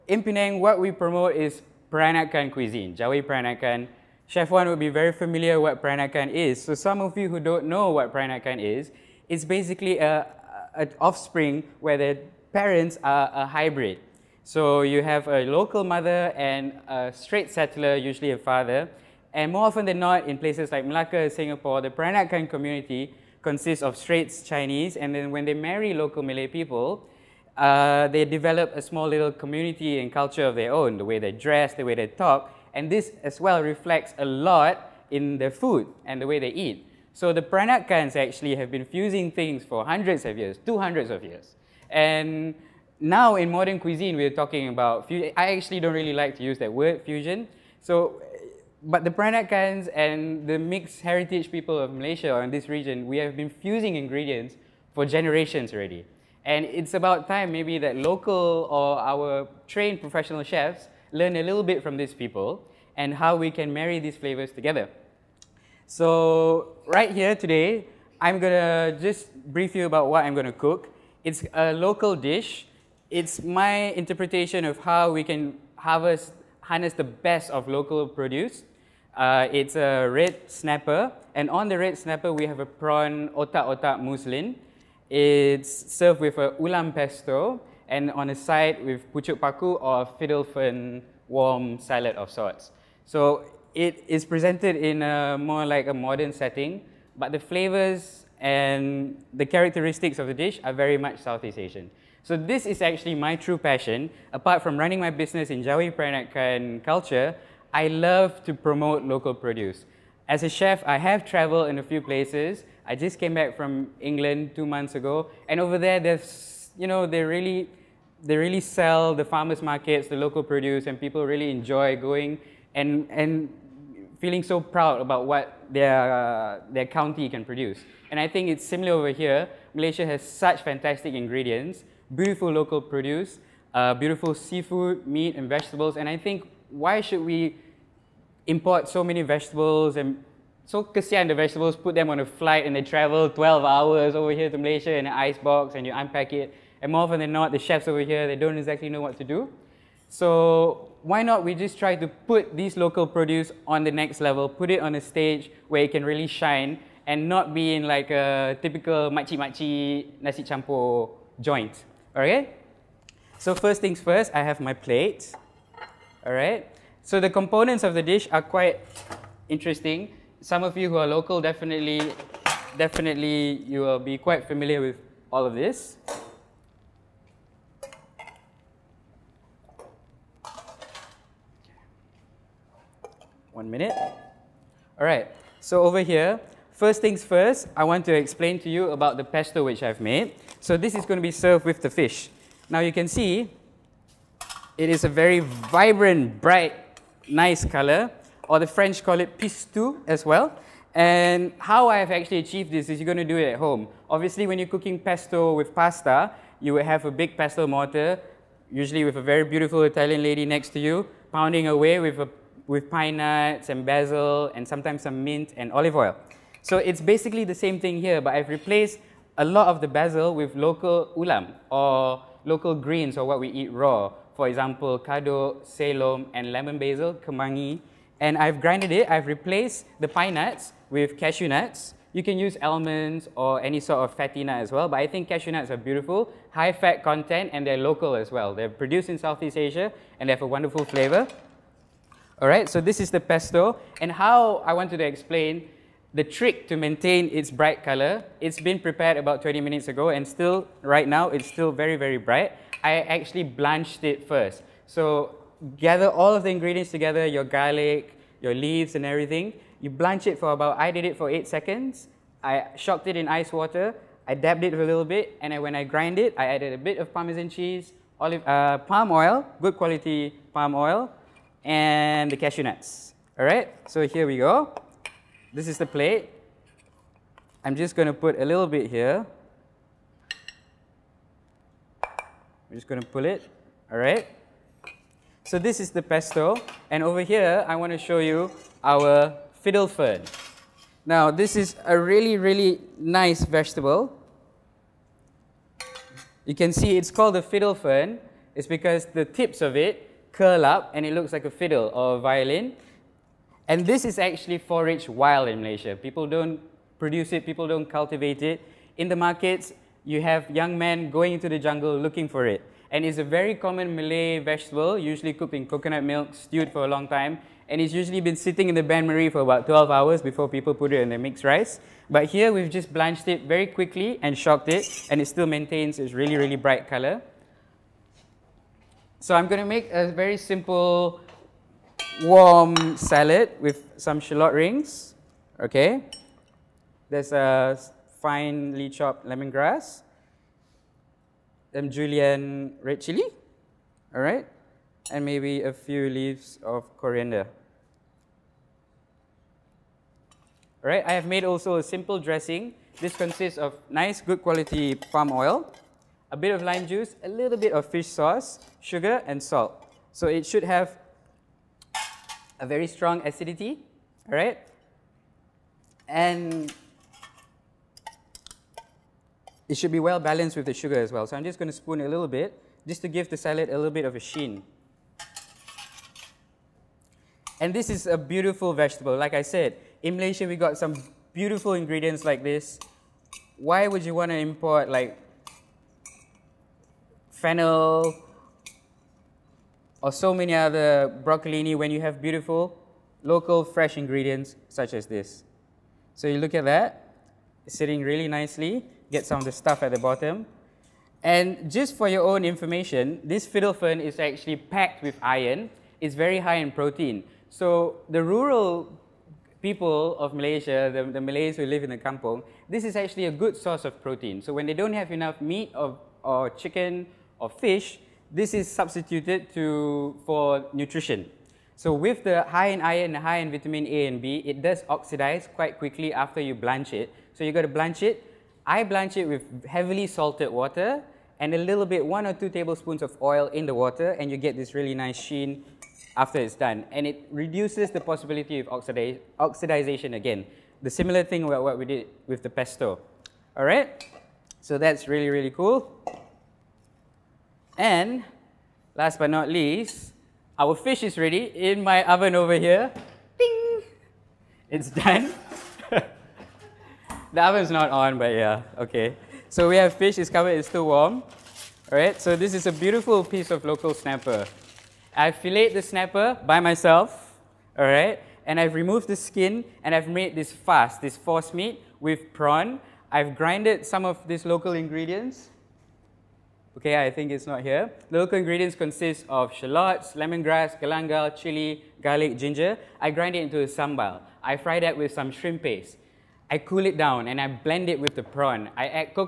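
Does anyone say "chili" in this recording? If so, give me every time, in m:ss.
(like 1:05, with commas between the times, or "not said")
5:43, 8:01.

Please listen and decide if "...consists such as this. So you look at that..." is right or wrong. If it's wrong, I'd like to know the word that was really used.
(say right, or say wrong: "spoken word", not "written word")
wrong: "ingredients", not "consists".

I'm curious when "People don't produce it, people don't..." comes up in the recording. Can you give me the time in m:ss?
5:05.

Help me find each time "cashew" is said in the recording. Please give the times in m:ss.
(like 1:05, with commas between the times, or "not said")
3:51, 3:55, 4:32.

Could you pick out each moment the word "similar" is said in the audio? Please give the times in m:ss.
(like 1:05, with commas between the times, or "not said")
2:08, 7:20.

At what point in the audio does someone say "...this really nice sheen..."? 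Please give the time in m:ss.
7:14.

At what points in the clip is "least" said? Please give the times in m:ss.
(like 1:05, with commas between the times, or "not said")
7:29.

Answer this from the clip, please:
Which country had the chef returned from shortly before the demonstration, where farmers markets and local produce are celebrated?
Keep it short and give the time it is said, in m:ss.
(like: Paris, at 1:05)
England, at 1:54.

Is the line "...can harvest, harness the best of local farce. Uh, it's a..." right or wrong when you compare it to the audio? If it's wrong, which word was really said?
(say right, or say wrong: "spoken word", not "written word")
wrong: "produce", not "farce".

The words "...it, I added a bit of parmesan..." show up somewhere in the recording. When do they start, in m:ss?
4:26.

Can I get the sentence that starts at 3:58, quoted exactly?
They're produced in Southeast Asia and they have a wonderful flavor.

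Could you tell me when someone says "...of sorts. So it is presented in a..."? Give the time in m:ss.
1:32.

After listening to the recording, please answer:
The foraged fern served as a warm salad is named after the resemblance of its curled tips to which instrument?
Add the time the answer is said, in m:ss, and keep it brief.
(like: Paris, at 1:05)
Violin, at 5:02.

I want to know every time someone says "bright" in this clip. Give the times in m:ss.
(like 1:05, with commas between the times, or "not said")
3:16, 4:07, 4:12, 5:26.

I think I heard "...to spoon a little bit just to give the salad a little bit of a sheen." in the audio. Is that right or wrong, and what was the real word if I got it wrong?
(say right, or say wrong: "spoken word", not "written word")
right.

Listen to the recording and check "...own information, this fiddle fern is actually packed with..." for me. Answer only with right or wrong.
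right.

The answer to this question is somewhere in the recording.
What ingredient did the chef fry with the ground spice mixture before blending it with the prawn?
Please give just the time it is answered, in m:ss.
8:05.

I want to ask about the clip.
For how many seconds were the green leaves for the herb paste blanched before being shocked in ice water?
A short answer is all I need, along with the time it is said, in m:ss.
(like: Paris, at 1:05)
8, at 4:21.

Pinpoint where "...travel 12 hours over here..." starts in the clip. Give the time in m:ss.
2:22.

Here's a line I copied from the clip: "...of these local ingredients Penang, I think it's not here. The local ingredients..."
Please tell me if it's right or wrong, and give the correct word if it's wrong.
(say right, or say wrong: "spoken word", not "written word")
wrong: "Okay", not "Penang".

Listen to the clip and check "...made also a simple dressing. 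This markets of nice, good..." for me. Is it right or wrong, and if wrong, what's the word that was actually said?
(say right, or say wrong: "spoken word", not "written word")
wrong: "consists", not "markets".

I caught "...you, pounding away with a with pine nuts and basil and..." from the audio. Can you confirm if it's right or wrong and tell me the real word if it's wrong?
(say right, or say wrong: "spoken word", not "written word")
right.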